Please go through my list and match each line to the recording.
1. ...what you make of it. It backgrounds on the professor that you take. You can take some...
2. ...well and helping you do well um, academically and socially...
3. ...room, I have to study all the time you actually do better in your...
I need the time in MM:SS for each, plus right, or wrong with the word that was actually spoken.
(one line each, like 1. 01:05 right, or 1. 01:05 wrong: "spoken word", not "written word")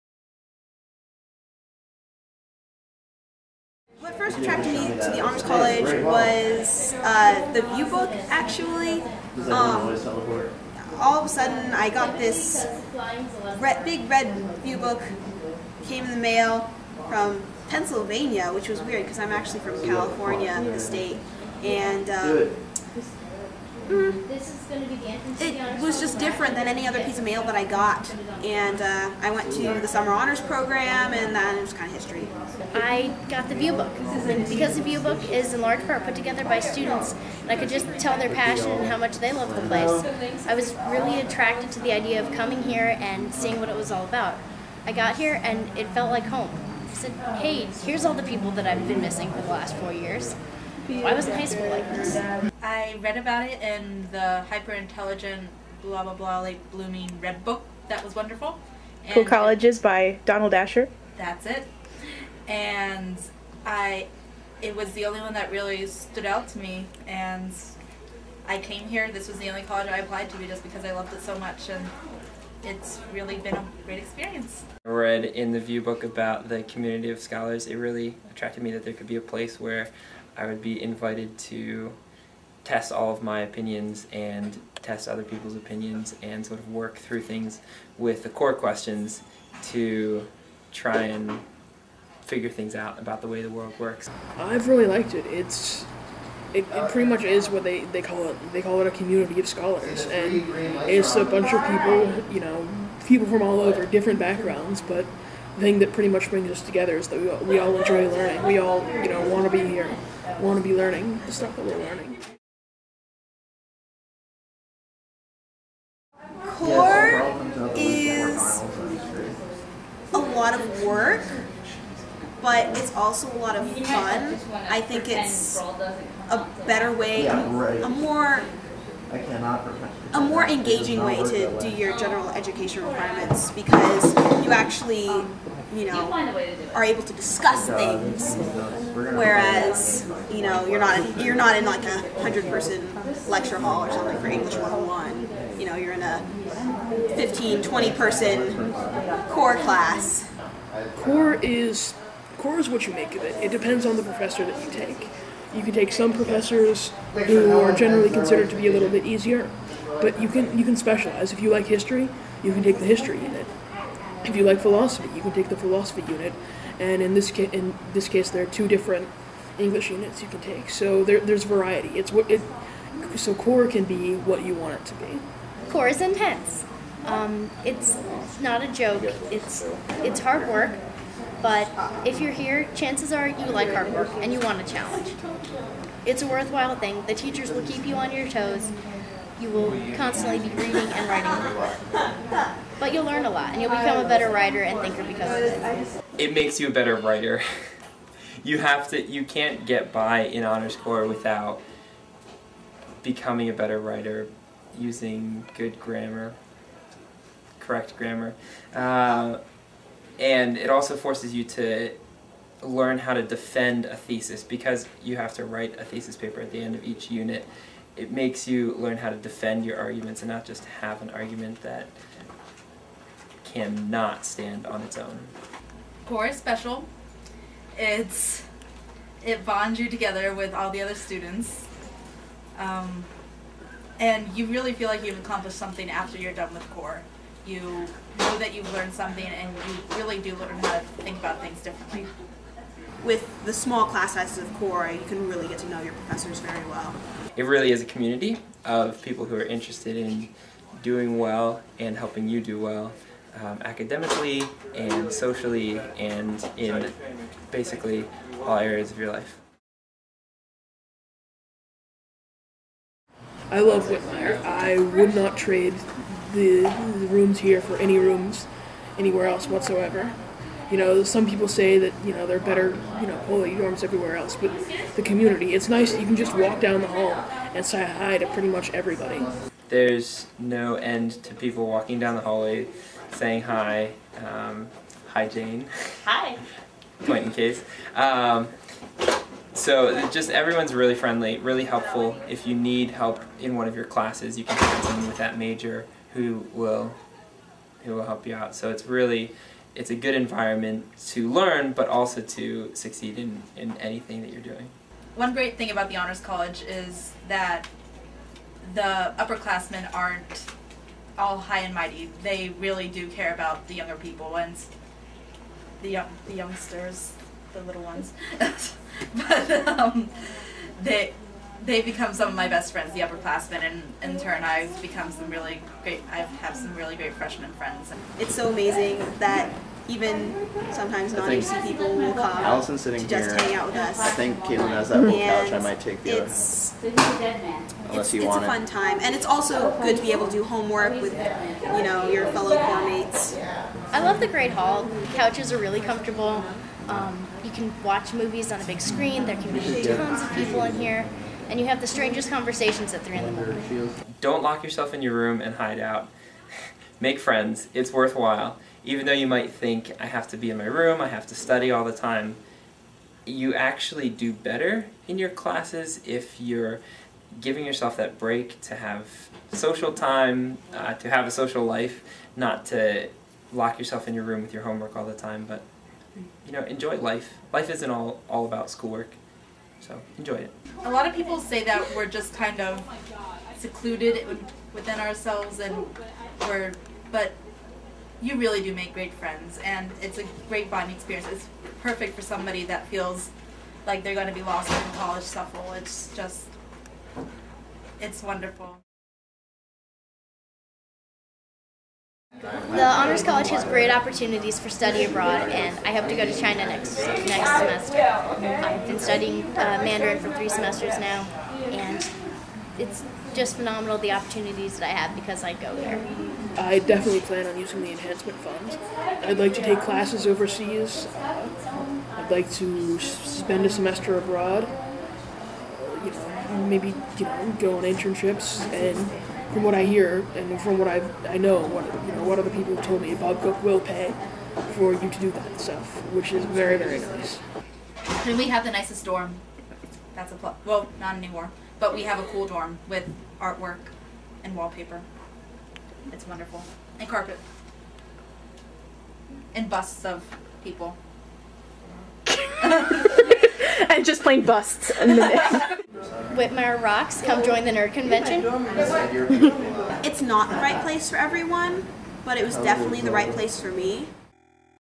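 1. 02:32 wrong: "depends", not "backgrounds"
2. 04:11 right
3. 06:00 right.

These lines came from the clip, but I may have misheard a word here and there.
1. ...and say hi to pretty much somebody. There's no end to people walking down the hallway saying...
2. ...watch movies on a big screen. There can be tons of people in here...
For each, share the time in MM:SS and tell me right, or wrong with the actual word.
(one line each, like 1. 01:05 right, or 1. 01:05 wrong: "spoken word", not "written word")
1. 04:37 wrong: "everybody", not "somebody"
2. 05:47 right.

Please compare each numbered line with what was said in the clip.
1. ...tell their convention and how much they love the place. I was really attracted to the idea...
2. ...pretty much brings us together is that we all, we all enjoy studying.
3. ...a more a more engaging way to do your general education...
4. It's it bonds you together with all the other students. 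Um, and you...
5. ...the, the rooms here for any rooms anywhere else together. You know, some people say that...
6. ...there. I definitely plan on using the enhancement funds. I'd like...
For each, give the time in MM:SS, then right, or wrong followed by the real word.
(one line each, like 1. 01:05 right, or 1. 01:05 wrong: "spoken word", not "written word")
1. 00:37 wrong: "passion", not "convention"
2. 01:45 wrong: "learning", not "studying"
3. 02:07 right
4. 03:47 right
5. 04:26 wrong: "whatsoever", not "together"
6. 06:55 right.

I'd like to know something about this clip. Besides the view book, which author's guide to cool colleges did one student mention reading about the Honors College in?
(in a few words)
Donald Asher.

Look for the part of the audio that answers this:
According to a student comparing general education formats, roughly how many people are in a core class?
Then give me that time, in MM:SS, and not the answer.
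02:27.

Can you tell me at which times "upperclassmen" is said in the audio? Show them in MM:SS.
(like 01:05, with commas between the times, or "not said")
05:09, 05:23.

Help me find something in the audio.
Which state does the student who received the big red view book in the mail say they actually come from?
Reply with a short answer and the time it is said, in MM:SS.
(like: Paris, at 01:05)
California, at 00:19.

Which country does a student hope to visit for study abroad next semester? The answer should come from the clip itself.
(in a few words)
China.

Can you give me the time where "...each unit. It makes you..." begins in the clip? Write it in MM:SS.
03:36.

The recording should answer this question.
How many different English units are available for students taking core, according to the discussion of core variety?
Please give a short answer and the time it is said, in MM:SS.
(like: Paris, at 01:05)
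2, at 02:48.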